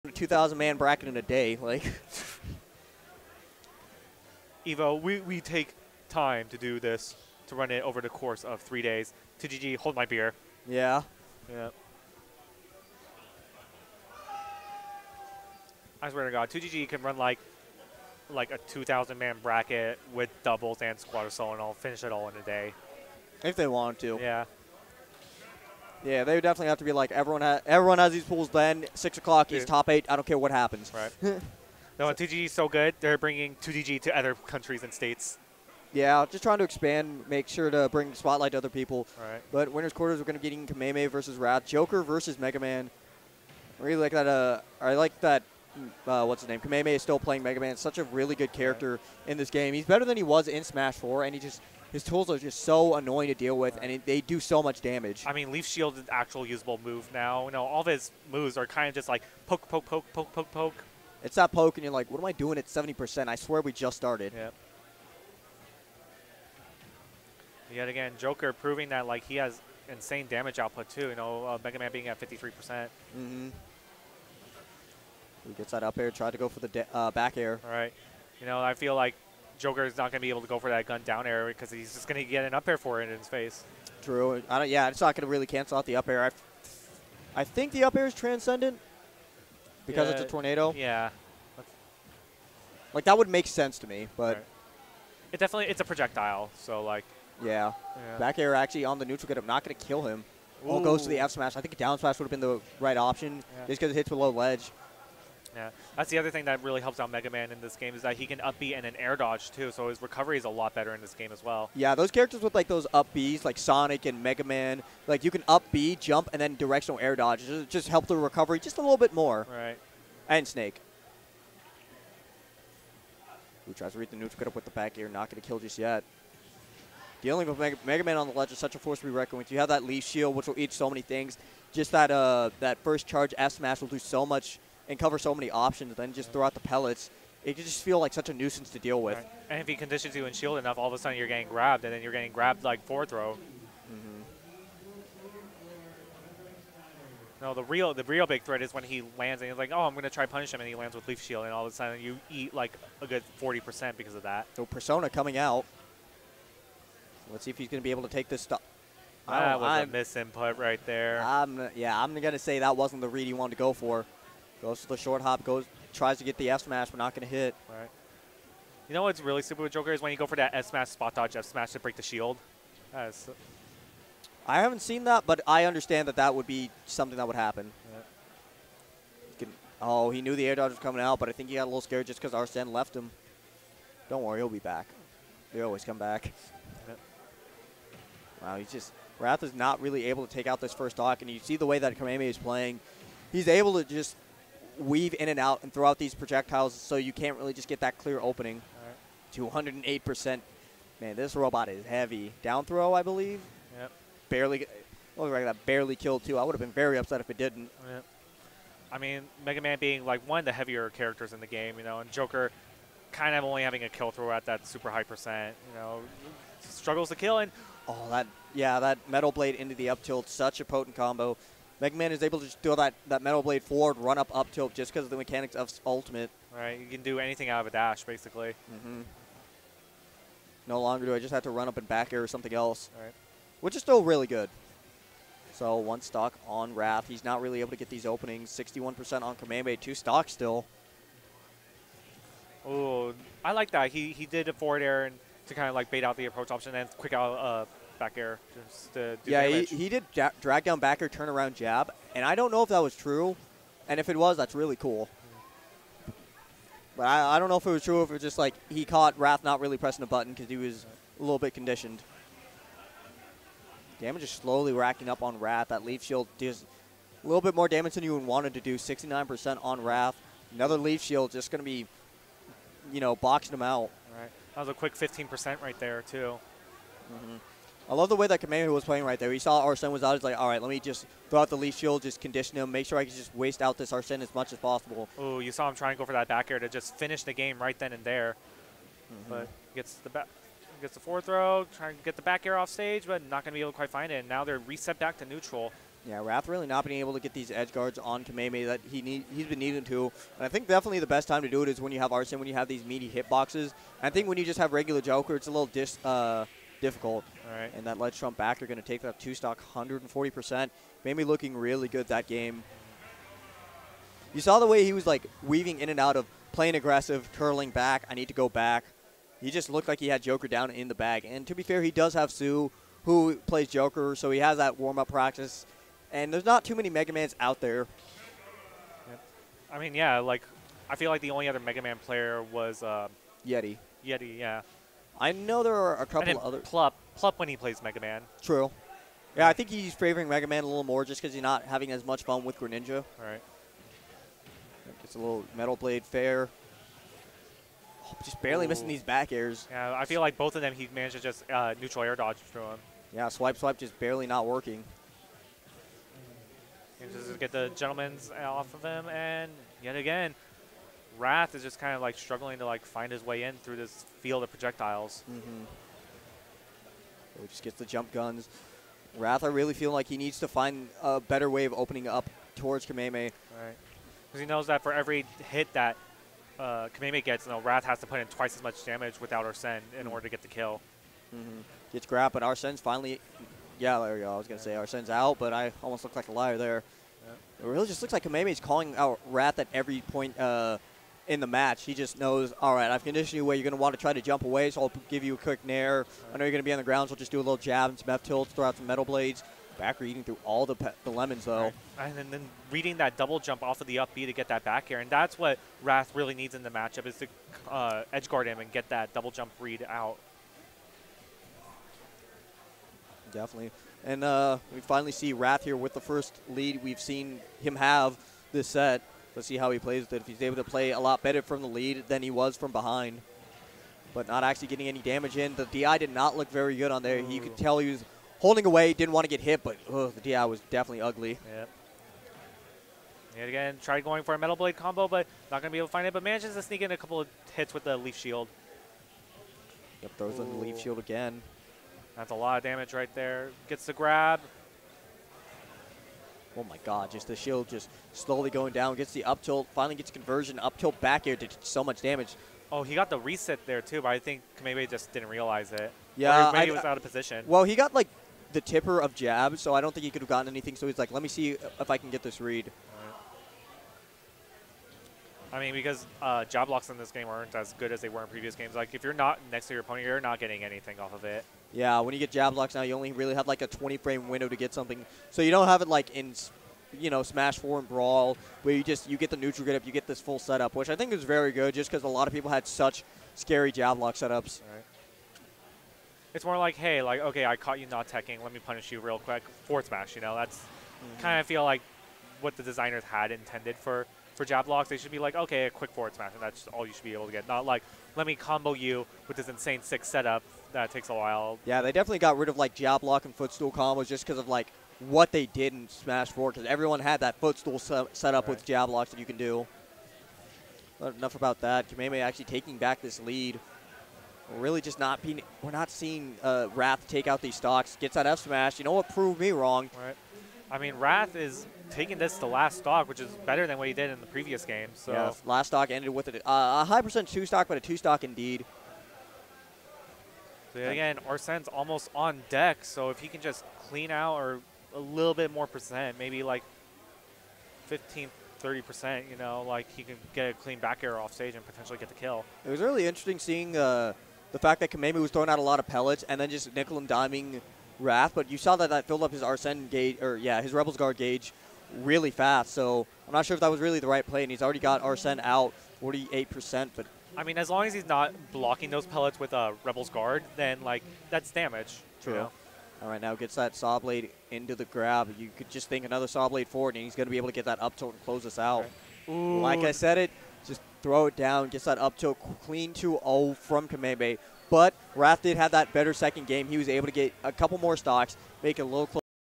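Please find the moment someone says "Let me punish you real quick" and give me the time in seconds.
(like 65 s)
488 s.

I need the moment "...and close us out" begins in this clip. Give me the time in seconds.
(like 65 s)
568 s.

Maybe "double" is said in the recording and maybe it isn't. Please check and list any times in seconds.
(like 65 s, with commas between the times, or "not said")
20 s, 403 s, 409 s.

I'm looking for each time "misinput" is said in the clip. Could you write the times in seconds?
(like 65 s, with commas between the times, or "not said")
159 s.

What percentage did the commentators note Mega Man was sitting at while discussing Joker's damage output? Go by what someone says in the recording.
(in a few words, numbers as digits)
53%.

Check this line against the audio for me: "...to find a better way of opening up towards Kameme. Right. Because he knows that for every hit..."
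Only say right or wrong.
right.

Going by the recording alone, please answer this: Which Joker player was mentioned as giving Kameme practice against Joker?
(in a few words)
Sue.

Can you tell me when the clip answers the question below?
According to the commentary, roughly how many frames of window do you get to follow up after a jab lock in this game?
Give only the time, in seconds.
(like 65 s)
473 s.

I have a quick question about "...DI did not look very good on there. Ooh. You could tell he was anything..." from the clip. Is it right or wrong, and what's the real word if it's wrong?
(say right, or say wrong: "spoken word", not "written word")
wrong: "holding", not "anything".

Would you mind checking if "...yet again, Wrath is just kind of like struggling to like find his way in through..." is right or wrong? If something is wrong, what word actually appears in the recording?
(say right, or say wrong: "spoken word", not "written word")
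right.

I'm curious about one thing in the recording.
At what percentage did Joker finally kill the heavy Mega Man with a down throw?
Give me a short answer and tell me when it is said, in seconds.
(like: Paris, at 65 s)
208%, at 200 s.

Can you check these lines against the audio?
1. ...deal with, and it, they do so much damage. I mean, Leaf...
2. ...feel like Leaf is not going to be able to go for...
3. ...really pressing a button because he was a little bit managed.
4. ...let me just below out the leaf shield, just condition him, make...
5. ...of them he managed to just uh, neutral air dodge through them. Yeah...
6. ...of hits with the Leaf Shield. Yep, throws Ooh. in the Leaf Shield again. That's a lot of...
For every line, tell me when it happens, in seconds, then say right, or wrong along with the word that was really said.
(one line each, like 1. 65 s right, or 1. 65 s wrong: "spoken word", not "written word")
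1. 53 s right
2. 78 s wrong: "Joker", not "Leaf"
3. 259 s wrong: "conditioned", not "managed"
4. 280 s wrong: "throw", not "below"
5. 350 s right
6. 437 s right.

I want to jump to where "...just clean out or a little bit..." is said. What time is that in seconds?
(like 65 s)
533 s.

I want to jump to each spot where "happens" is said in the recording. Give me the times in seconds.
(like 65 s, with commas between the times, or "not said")
30 s, 177 s.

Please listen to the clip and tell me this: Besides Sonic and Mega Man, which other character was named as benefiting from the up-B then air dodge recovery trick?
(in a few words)
Snake.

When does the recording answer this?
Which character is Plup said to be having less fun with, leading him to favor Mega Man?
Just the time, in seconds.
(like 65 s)
342 s.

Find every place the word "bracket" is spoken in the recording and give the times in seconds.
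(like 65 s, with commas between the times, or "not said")
0 s, 19 s.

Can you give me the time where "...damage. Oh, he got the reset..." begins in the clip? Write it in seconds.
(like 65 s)
452 s.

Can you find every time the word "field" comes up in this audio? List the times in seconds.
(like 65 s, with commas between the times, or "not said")
364 s.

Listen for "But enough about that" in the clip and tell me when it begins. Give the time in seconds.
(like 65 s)
510 s.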